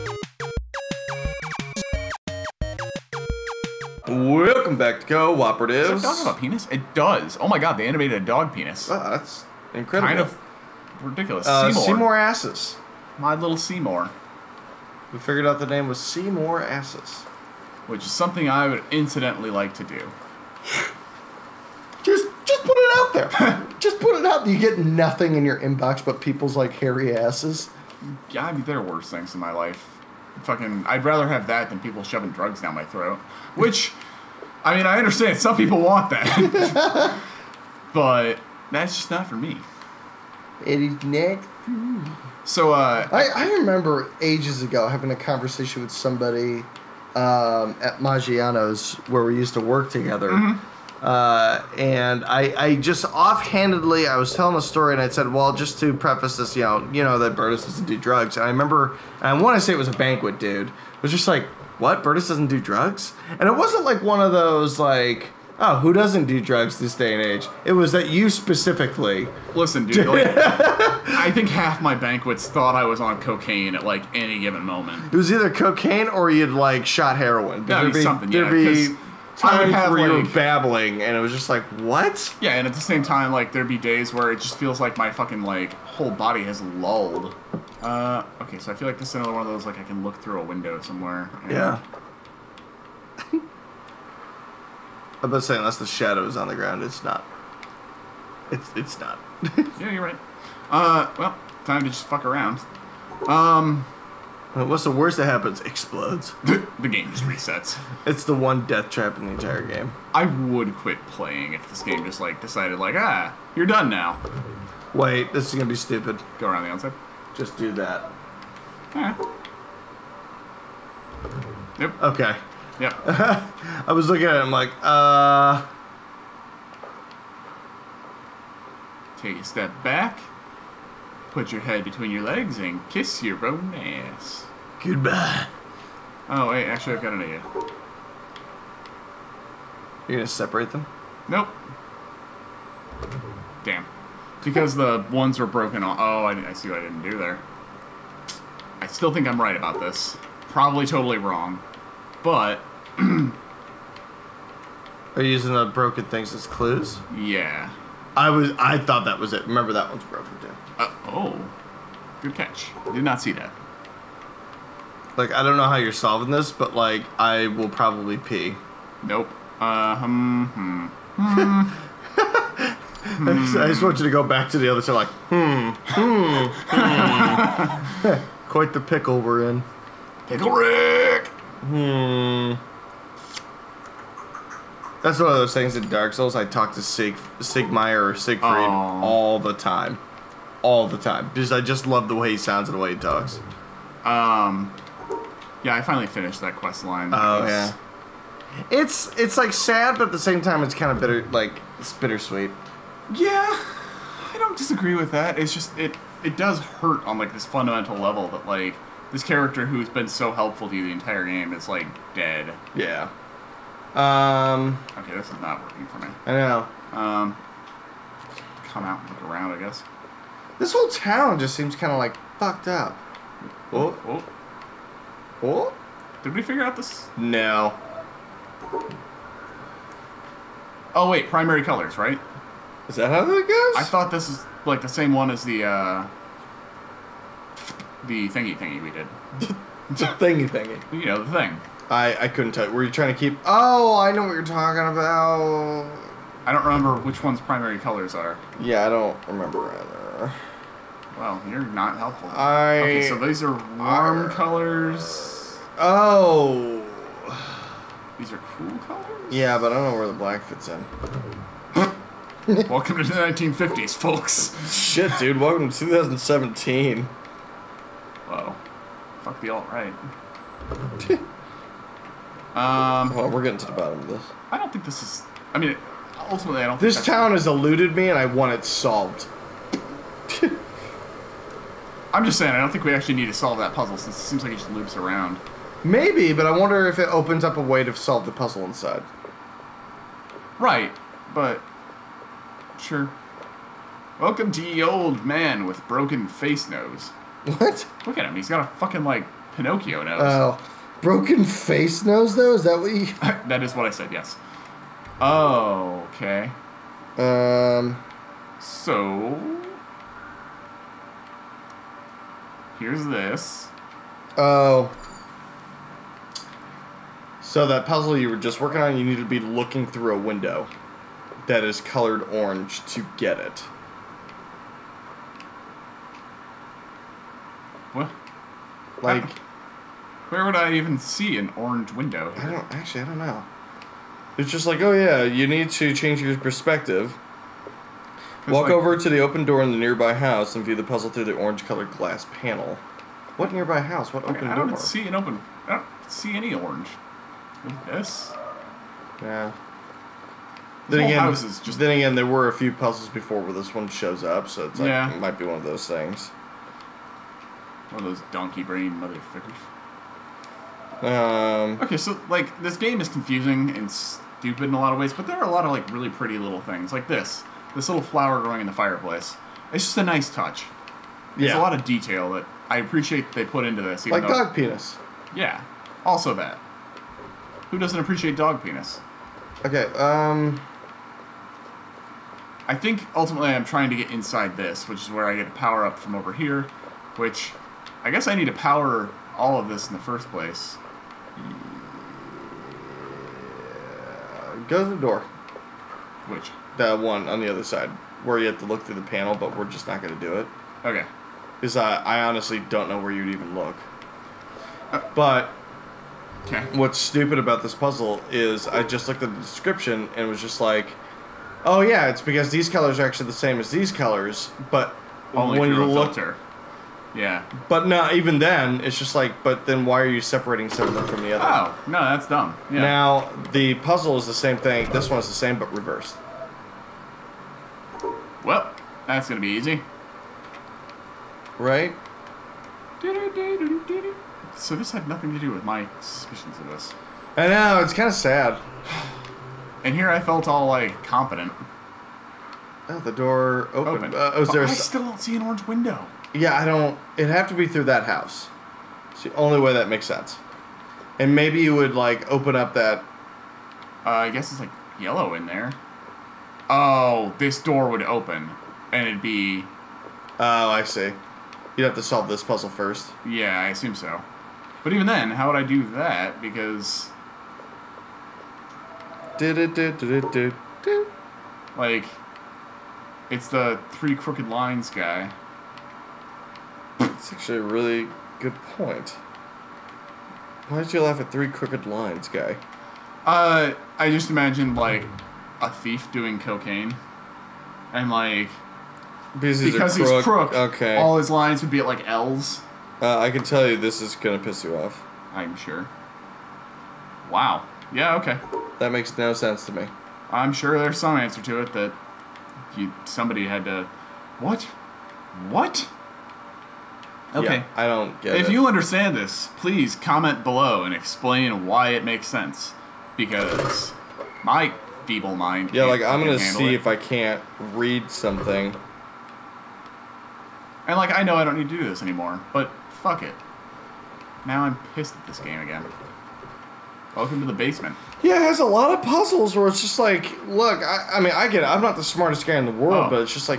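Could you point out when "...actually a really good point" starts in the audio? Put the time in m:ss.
7:57.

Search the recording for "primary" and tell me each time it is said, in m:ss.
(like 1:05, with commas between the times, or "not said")
3:51, 4:07.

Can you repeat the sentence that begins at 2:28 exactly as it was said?
I still think I'm right about this.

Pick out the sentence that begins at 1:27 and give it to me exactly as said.
Uh, okay, so I feel like this is another one of those like I can look through a window somewhere.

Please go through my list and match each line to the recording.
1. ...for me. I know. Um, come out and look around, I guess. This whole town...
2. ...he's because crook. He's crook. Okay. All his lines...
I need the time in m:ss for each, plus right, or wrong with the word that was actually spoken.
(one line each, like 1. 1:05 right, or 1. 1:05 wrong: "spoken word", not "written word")
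1. 3:35 right
2. 8:09 right.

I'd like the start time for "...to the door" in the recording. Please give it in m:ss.
6:34.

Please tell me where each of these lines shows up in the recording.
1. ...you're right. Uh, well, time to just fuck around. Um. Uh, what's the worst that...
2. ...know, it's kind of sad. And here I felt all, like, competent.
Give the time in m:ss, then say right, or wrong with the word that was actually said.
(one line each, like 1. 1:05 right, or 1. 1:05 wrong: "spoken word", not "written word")
1. 1:39 right
2. 7:17 right.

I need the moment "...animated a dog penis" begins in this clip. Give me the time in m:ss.
0:07.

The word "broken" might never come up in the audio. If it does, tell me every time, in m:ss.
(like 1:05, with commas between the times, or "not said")
2:25, 2:35, 2:40, 4:55, 5:01.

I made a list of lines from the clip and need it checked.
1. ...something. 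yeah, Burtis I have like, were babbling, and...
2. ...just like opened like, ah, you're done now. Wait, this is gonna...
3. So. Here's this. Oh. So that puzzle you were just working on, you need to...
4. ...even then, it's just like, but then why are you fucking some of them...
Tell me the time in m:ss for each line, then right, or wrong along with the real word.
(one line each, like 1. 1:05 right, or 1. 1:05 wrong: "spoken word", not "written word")
1. 1:18 wrong: "Time", not "Burtis"
2. 1:52 wrong: "decided", not "opened"
3. 5:08 right
4. 6:58 wrong: "separating", not "fucking".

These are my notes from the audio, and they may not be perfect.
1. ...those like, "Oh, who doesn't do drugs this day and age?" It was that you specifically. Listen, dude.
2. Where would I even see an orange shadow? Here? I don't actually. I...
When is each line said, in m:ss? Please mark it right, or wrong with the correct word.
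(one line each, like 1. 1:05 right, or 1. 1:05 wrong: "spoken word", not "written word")
1. 1:04 right
2. 5:30 wrong: "window", not "shadow".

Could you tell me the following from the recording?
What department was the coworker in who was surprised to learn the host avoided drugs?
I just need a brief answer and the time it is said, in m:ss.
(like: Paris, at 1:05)
banquet, at 0:59.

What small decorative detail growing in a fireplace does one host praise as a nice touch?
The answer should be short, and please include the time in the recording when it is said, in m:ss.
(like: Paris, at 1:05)
flower, at 6:08.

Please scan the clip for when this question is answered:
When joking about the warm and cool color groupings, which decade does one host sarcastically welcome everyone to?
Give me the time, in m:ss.
4:23.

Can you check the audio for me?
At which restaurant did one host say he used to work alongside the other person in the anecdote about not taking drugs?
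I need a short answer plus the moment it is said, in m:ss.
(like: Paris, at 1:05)
Maggiano's, at 0:47.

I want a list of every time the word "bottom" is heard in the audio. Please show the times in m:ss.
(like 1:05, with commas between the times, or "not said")
4:33.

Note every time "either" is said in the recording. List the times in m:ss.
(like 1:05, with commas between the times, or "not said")
1:15, 4:09.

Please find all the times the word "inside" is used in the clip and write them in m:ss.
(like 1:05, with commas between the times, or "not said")
4:48, 6:24.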